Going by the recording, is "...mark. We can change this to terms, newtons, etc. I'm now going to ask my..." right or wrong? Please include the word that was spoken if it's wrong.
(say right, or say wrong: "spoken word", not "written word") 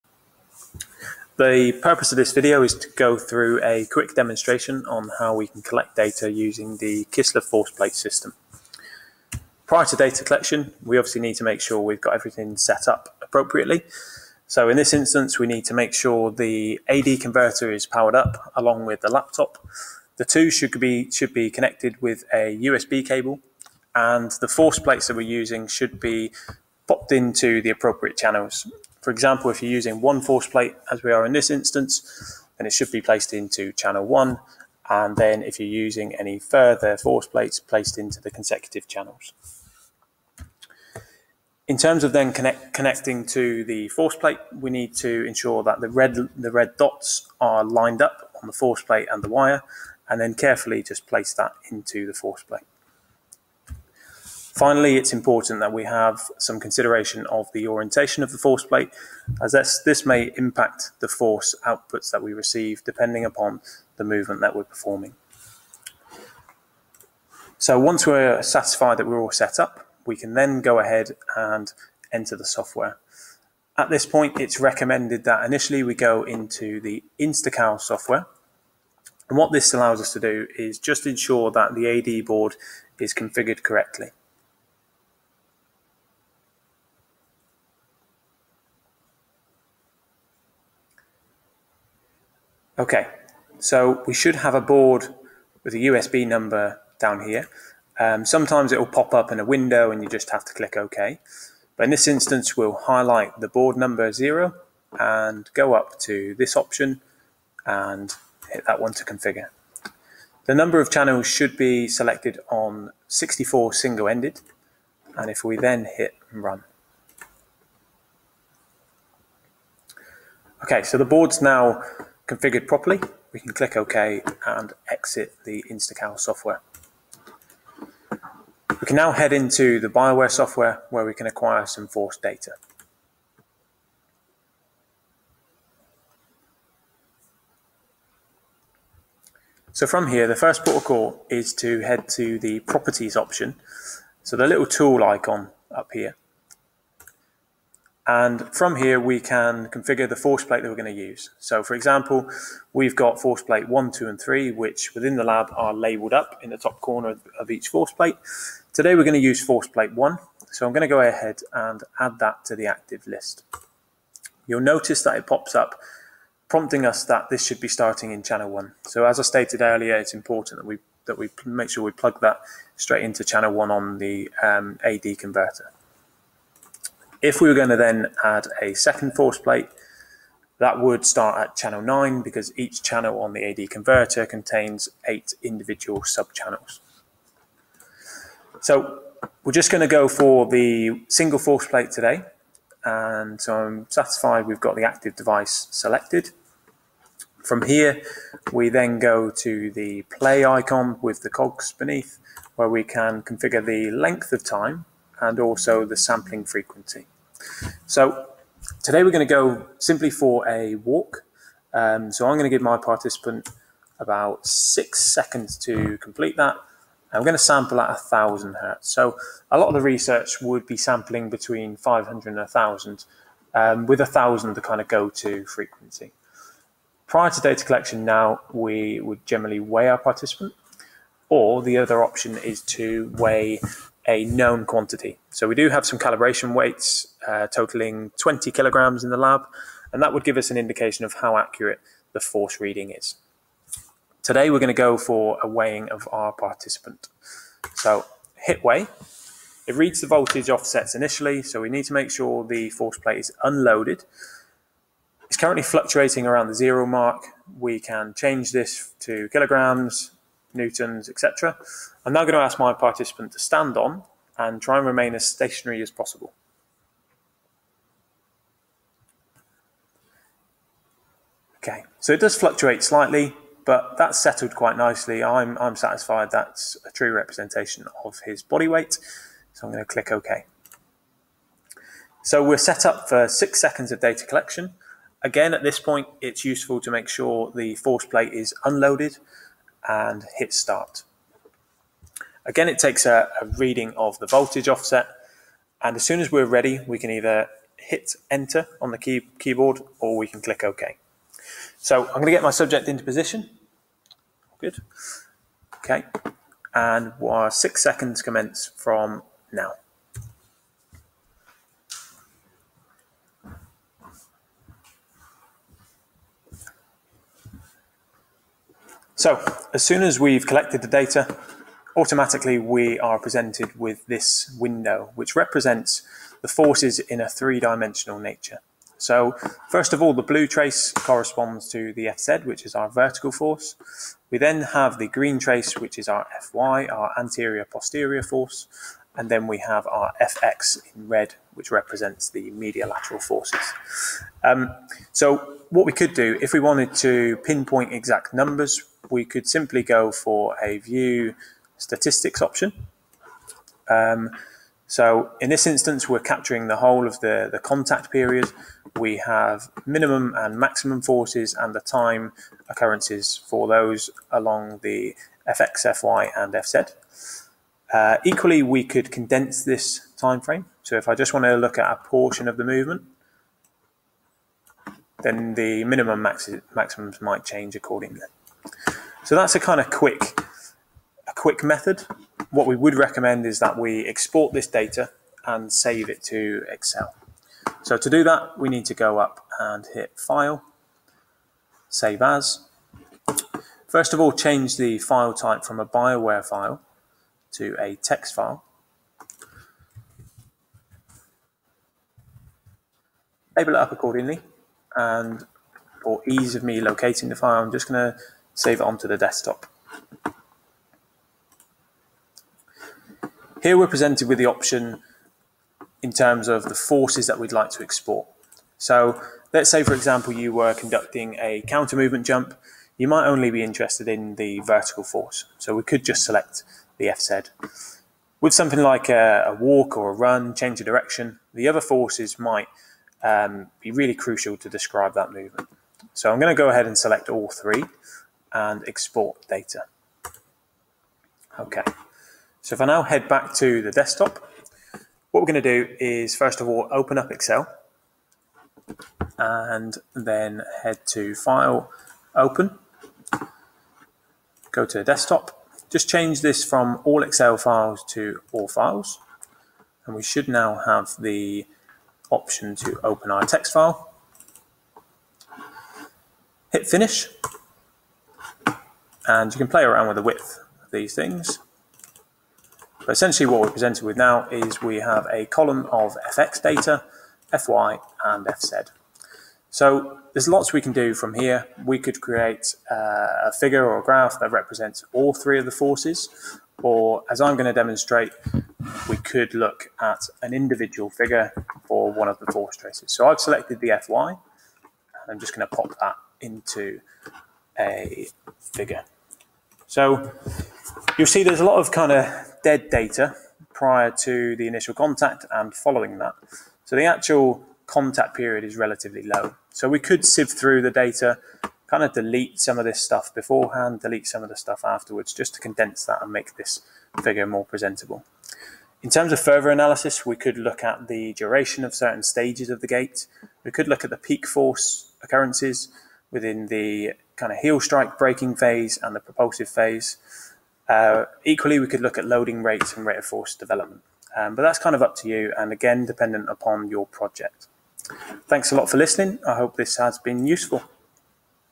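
wrong: "kilograms", not "terms".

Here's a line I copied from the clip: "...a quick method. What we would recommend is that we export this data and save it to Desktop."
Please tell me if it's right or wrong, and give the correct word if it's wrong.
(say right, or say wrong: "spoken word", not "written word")
wrong: "Excel", not "Desktop".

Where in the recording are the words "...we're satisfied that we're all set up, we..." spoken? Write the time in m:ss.
1:08.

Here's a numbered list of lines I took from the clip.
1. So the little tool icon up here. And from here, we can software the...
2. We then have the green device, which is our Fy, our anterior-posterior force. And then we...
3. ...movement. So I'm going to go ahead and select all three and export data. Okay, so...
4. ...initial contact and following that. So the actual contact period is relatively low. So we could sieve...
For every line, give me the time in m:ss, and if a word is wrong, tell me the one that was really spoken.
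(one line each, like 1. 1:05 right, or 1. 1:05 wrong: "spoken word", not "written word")
1. 2:24 wrong: "configure", not "software"
2. 5:34 wrong: "trace", not "device"
3. 7:15 right
4. 8:24 right.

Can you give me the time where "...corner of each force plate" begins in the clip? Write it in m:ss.
2:36.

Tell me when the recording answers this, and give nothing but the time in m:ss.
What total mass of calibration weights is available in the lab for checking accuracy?
3:58.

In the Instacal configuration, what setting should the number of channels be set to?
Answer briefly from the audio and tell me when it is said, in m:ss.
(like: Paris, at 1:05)
64 single-ended, at 1:53.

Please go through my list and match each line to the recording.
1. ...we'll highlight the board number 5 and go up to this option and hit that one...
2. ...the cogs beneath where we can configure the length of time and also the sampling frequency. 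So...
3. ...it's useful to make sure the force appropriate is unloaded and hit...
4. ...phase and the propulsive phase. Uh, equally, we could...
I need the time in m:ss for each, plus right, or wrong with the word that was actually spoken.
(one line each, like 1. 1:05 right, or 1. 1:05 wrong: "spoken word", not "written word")
1. 1:42 wrong: "0", not "5"
2. 3:21 right
3. 4:46 wrong: "plate", not "appropriate"
4. 8:48 right.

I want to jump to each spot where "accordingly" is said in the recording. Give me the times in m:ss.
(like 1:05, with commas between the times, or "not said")
6:17, 6:43.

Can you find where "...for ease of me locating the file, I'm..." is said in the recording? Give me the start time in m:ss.
6:46.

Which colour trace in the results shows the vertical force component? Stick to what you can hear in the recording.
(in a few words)
Blue.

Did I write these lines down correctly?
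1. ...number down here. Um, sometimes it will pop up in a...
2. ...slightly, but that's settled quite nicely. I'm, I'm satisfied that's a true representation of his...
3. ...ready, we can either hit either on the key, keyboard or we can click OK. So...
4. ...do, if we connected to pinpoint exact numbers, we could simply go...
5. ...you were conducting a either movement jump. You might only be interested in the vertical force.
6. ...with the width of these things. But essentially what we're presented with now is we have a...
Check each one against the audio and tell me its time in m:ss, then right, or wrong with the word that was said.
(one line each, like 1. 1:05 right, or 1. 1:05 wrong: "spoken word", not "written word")
1. 1:36 right
2. 4:32 right
3. 4:56 wrong: "enter", not "either"
4. 5:46 wrong: "wanted", not "connected"
5. 7:00 wrong: "counter", not "either"
6. 7:50 right.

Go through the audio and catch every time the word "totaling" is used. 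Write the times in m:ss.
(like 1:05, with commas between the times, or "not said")
3:57.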